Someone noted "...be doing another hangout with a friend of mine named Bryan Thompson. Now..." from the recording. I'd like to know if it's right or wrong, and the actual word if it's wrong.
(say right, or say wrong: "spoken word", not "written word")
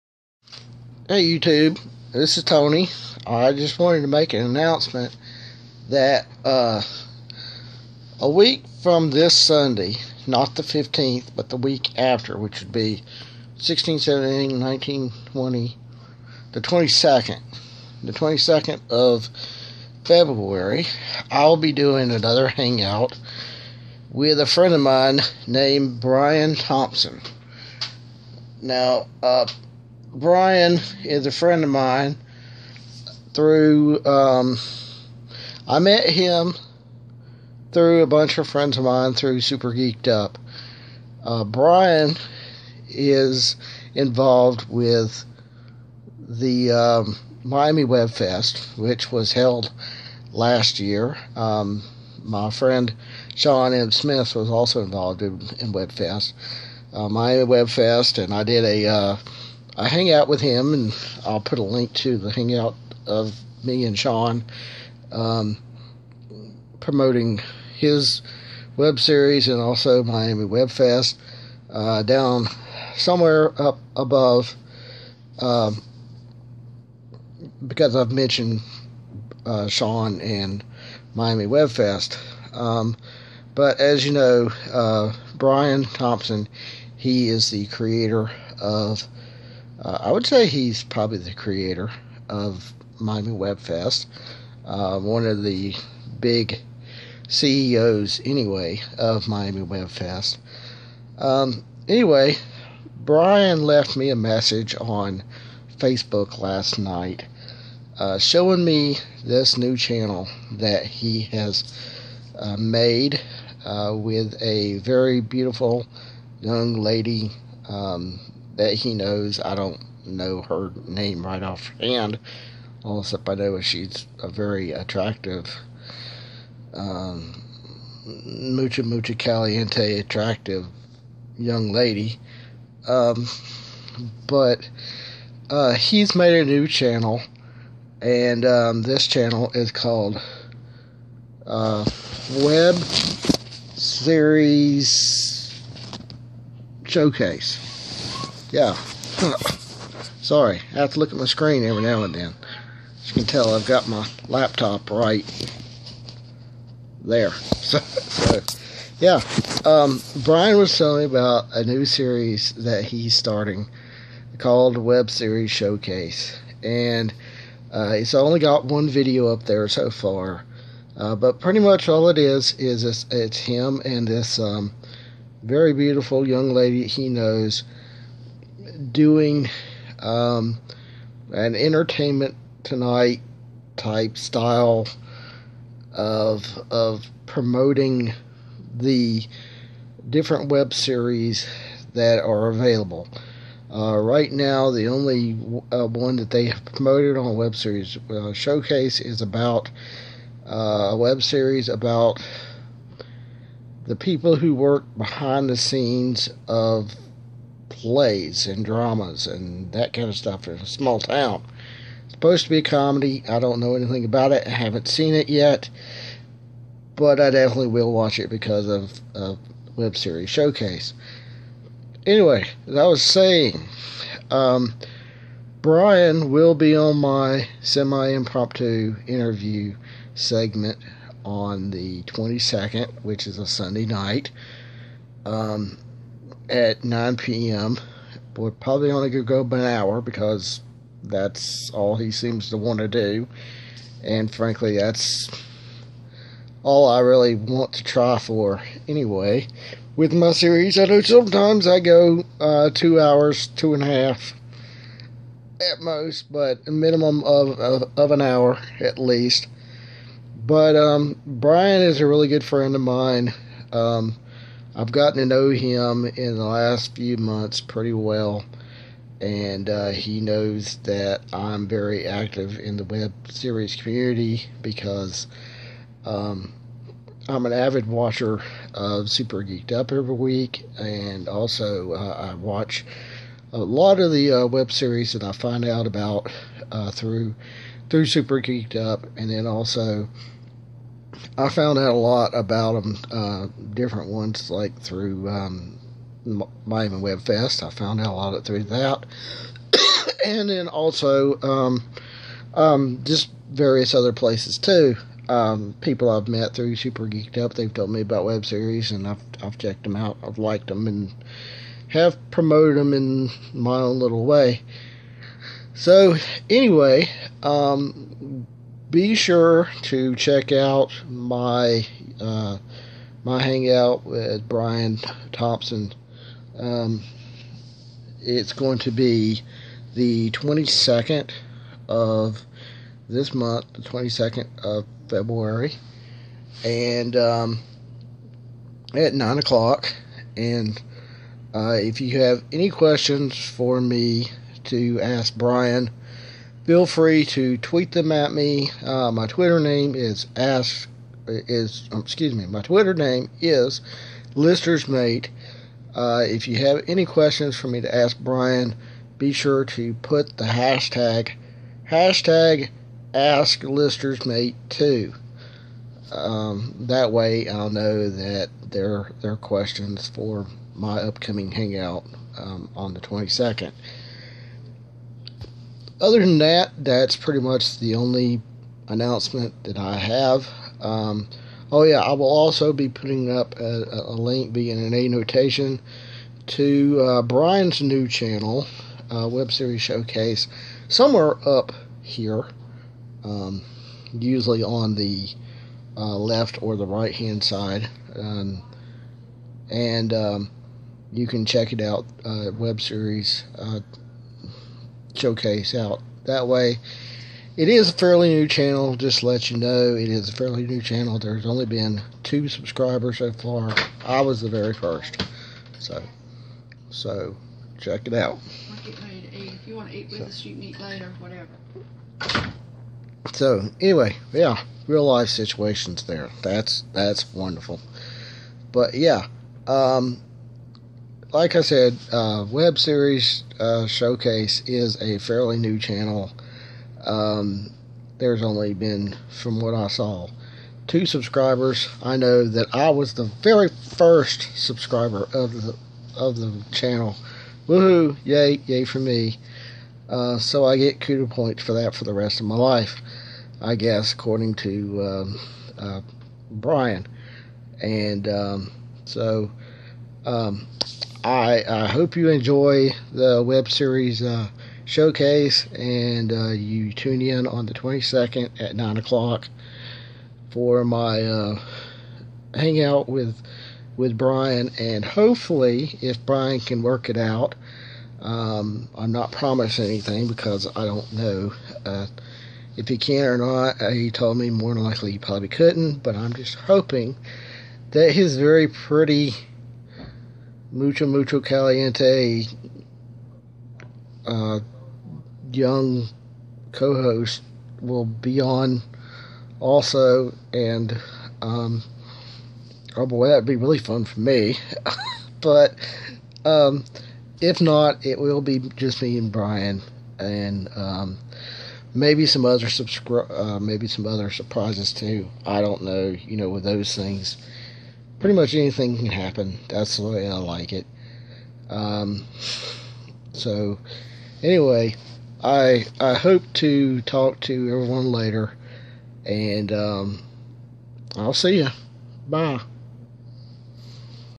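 right.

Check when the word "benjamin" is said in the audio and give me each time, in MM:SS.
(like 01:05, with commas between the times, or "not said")
not said.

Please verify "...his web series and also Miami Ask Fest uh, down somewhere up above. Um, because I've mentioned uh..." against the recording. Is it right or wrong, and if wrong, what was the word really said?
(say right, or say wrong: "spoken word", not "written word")
wrong: "Web", not "Ask".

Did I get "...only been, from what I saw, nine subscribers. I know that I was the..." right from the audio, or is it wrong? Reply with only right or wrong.
wrong.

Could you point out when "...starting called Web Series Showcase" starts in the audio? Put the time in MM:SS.
02:43.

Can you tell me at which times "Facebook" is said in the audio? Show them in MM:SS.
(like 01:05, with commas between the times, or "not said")
01:45.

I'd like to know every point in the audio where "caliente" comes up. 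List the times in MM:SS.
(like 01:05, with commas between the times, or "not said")
02:09, 08:11.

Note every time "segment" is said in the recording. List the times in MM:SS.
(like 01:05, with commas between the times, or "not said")
03:50.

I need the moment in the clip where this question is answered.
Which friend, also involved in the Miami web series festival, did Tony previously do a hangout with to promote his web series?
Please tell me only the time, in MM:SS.
00:53.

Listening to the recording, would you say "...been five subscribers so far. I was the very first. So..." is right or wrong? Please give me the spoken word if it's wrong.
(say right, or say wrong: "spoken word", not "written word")
wrong: "two", not "five".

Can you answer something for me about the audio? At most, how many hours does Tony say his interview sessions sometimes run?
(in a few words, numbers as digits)
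Two and a half.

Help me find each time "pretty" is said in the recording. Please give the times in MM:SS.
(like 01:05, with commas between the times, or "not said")
02:51, 04:27, 06:17, 08:08, 08:38.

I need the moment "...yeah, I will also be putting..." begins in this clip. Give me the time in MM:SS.
06:21.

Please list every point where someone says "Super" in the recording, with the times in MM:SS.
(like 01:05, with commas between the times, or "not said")
00:39, 04:39, 04:48, 05:06.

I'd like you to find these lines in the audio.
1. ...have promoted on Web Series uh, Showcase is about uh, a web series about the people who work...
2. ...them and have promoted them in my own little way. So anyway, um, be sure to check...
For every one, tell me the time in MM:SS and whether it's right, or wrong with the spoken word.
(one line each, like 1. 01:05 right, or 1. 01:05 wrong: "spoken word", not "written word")
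1. 03:16 right
2. 05:10 right.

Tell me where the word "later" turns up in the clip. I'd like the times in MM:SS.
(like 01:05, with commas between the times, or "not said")
07:00, 08:48.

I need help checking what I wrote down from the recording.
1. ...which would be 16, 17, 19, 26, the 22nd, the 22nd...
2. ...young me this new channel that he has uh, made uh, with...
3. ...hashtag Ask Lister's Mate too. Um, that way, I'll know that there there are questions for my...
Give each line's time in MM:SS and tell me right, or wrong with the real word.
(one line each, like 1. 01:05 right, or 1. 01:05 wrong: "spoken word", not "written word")
1. 00:12 wrong: "20", not "26"
2. 01:48 wrong: "showing", not "young"
3. 06:01 right.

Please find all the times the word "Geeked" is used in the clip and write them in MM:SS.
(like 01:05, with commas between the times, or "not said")
00:39, 04:39, 04:48, 05:07.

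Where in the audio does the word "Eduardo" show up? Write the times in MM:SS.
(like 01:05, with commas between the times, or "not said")
not said.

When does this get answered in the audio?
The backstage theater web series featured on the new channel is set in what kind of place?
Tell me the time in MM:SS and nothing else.
03:30.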